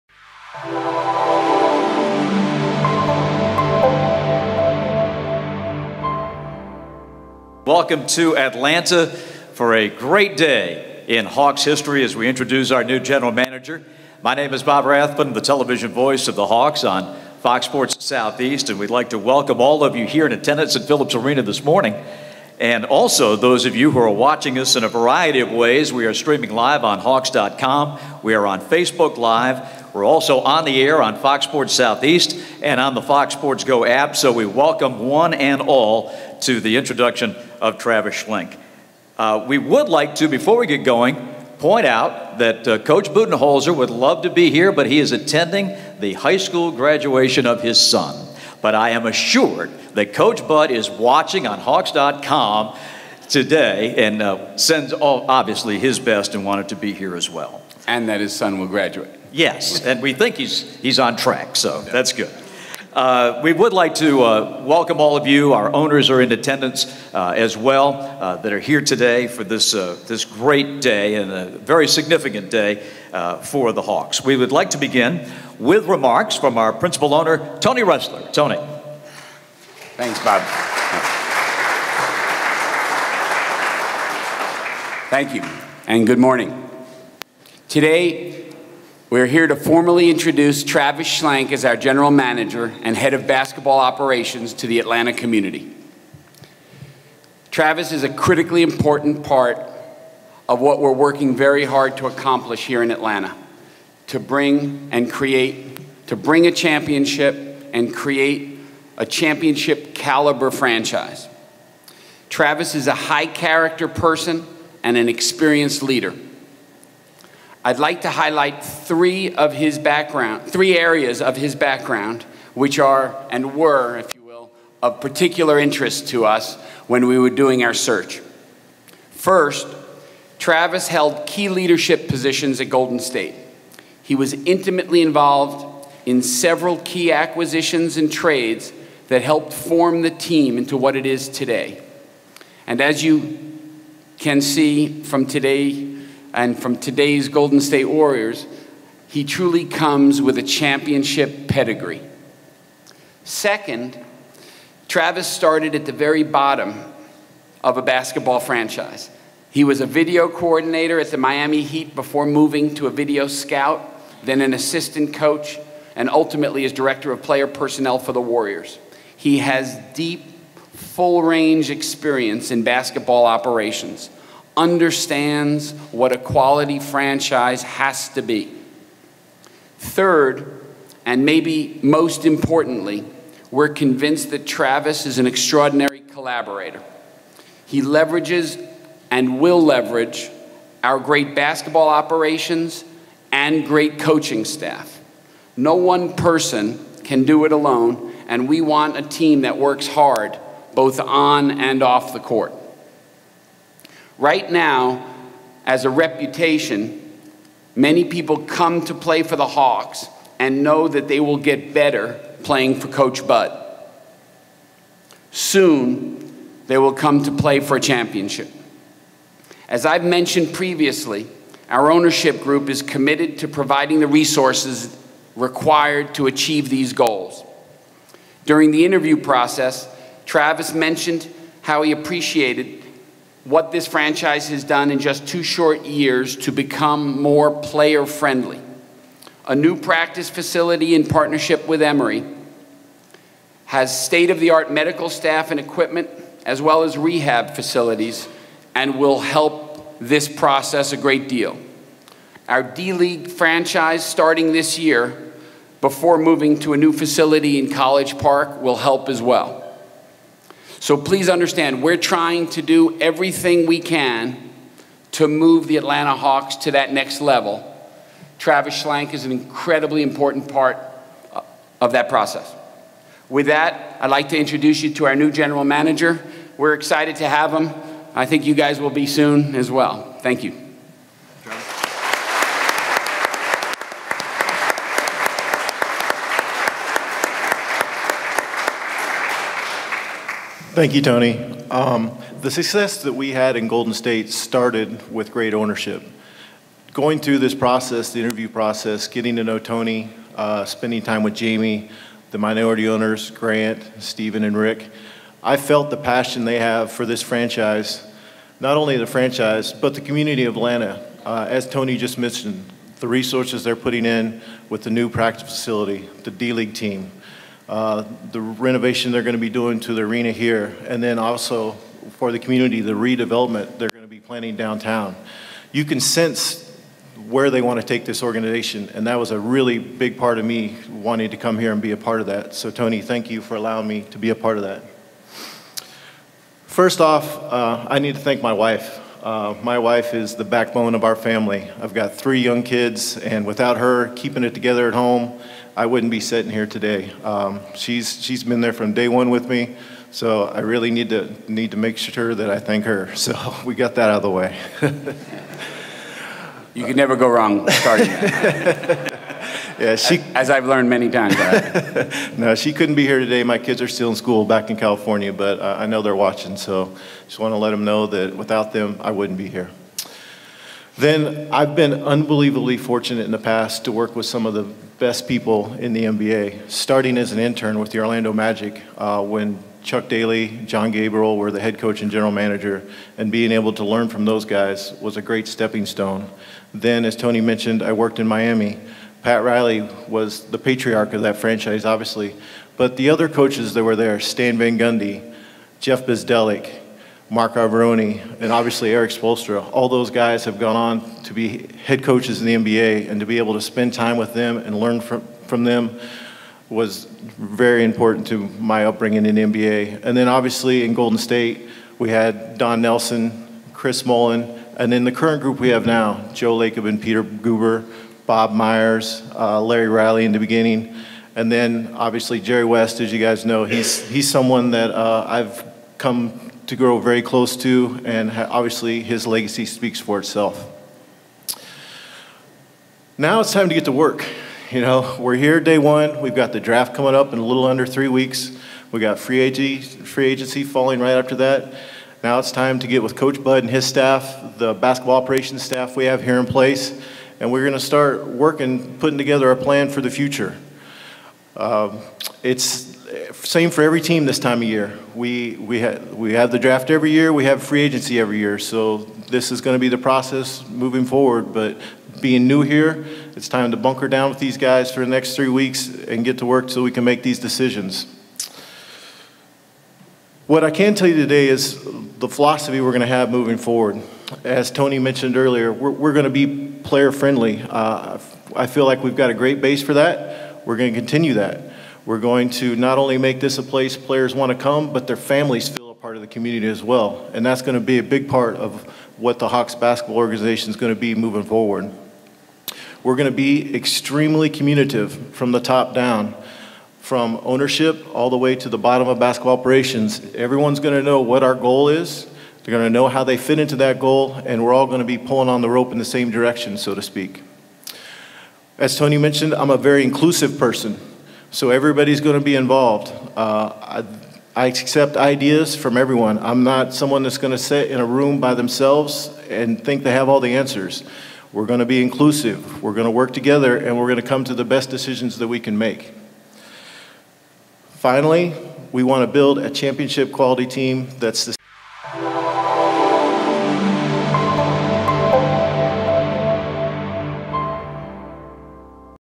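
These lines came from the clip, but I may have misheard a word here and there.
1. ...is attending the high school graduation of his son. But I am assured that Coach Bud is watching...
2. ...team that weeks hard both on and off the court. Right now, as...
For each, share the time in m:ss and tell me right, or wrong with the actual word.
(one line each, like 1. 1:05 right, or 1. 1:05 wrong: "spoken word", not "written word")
1. 0:44 right
2. 3:19 wrong: "works", not "weeks".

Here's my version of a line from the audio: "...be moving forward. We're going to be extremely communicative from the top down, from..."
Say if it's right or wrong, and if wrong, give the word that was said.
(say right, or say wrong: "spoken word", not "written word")
right.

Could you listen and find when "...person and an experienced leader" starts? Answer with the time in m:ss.
1:53.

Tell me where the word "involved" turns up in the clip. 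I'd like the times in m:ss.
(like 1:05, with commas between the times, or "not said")
2:15, 8:32.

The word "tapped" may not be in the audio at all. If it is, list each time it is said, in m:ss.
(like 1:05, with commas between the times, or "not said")
not said.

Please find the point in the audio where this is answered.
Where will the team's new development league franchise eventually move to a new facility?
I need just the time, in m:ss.
4:17.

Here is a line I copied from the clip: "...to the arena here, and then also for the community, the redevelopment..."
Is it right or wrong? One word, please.
right.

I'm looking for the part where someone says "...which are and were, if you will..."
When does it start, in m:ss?
2:02.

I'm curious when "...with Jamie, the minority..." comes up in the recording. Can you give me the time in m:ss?
5:01.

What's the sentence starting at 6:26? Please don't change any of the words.
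Then, as Tony mentioned, I worked in Miami.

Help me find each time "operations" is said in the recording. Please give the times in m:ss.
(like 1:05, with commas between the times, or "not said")
1:33, 2:53, 3:11, 7:25, 8:19.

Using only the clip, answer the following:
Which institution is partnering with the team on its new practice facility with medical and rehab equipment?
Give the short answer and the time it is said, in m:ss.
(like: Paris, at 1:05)
Emory, at 4:01.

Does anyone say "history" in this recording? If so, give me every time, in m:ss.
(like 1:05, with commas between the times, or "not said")
0:11.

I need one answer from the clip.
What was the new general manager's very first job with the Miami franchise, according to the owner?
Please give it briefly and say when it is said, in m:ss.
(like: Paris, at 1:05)
Video coordinator, at 2:39.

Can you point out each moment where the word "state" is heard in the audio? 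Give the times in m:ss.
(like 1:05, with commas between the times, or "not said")
2:12, 2:27, 4:04, 4:53, 6:51.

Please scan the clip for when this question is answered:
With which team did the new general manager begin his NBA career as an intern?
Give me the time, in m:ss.
6:17.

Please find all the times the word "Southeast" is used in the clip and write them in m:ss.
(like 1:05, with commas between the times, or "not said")
0:18, 0:31.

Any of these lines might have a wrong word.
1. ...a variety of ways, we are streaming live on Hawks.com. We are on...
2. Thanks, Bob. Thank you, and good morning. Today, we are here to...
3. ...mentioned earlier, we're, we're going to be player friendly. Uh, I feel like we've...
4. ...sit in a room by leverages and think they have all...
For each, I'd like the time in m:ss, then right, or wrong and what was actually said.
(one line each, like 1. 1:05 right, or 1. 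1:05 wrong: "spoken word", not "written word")
1. 0:24 right
2. 1:19 right
3. 7:54 right
4. 8:37 wrong: "themselves", not "leverages".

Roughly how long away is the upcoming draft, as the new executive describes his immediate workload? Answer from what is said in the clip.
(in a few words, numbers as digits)
Under 3 weeks.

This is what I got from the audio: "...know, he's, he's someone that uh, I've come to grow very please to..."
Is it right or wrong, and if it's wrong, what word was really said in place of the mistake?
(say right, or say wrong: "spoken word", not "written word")
wrong: "close", not "please".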